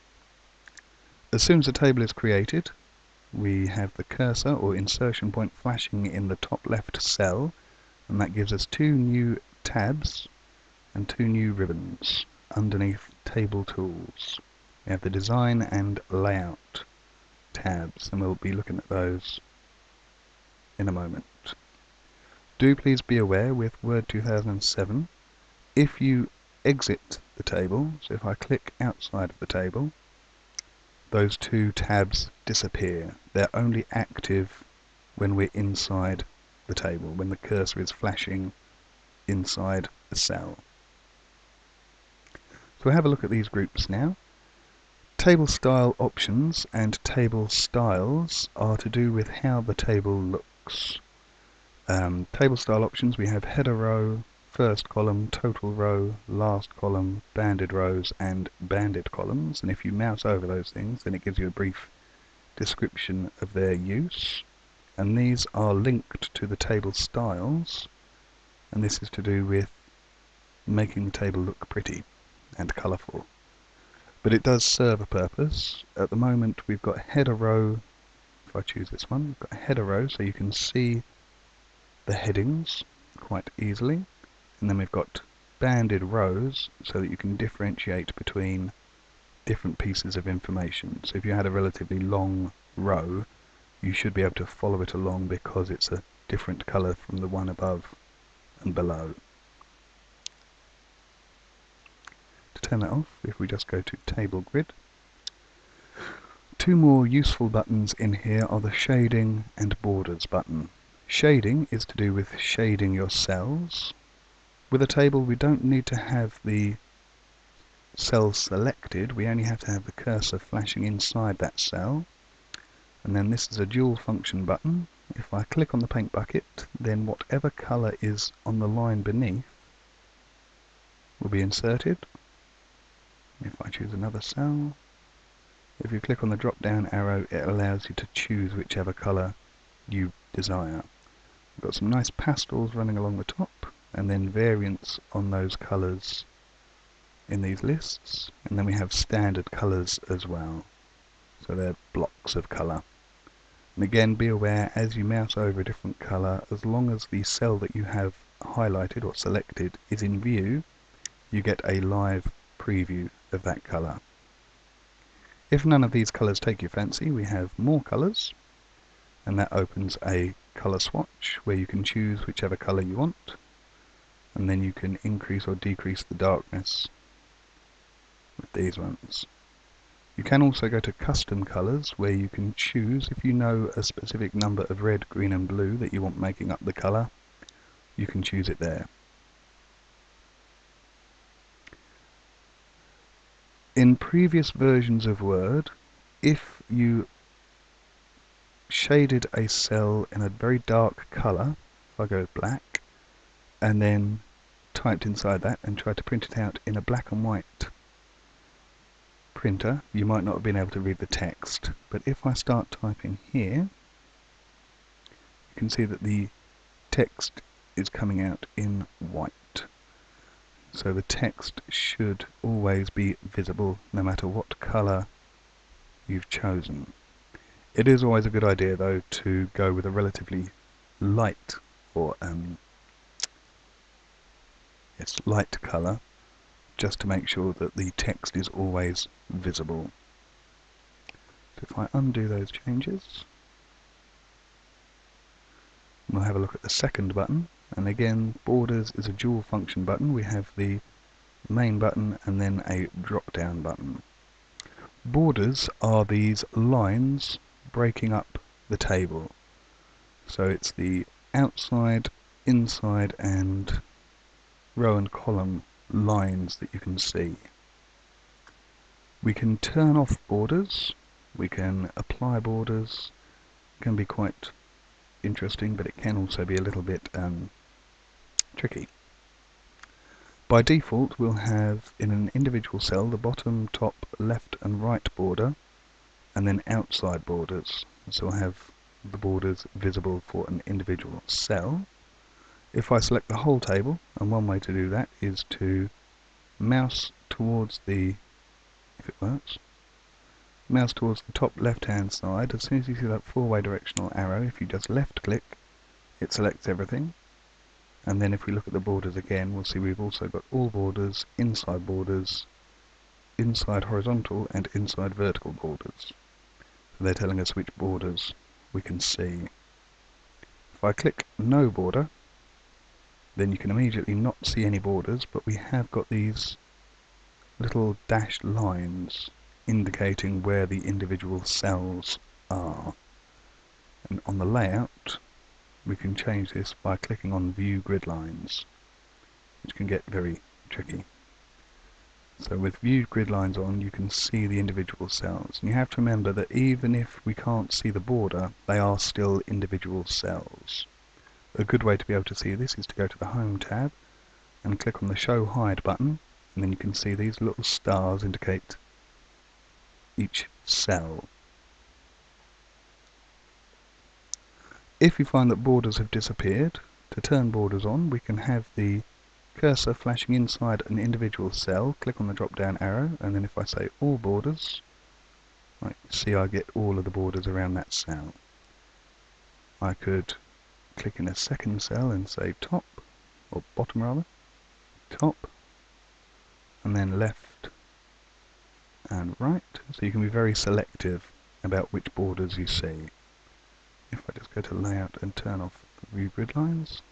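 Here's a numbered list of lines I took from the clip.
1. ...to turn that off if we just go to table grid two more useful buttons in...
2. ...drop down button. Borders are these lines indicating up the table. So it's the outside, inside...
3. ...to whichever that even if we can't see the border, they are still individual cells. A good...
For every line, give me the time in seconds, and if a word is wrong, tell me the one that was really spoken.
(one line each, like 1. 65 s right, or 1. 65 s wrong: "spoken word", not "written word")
1. 102 s right
2. 253 s wrong: "breaking", not "indicating"
3. 345 s wrong: "remember", not "whichever".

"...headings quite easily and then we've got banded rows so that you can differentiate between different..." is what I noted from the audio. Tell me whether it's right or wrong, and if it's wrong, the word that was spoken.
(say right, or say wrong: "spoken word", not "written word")
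right.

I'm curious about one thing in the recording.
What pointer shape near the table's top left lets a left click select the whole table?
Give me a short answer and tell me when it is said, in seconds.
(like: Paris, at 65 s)
Four way directional arrow, at 303 s.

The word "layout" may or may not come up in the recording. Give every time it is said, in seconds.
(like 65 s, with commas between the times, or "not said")
16 s, 334 s, 394 s.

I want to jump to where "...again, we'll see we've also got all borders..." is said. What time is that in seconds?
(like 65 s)
309 s.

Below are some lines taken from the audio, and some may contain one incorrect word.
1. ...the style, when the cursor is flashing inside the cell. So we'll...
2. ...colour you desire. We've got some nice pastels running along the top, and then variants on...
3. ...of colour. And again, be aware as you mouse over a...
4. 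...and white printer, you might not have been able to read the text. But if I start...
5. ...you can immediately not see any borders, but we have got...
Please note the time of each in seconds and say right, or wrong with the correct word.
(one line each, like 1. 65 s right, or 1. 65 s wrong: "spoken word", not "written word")
1. 36 s wrong: "table", not "style"
2. 138 s right
3. 152 s right
4. 207 s right
5. 323 s right.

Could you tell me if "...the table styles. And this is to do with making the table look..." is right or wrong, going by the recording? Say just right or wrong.
right.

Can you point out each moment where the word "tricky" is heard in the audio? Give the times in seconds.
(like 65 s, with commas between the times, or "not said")
278 s, 340 s.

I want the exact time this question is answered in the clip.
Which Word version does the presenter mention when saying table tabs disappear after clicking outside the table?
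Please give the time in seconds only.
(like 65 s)
23 s.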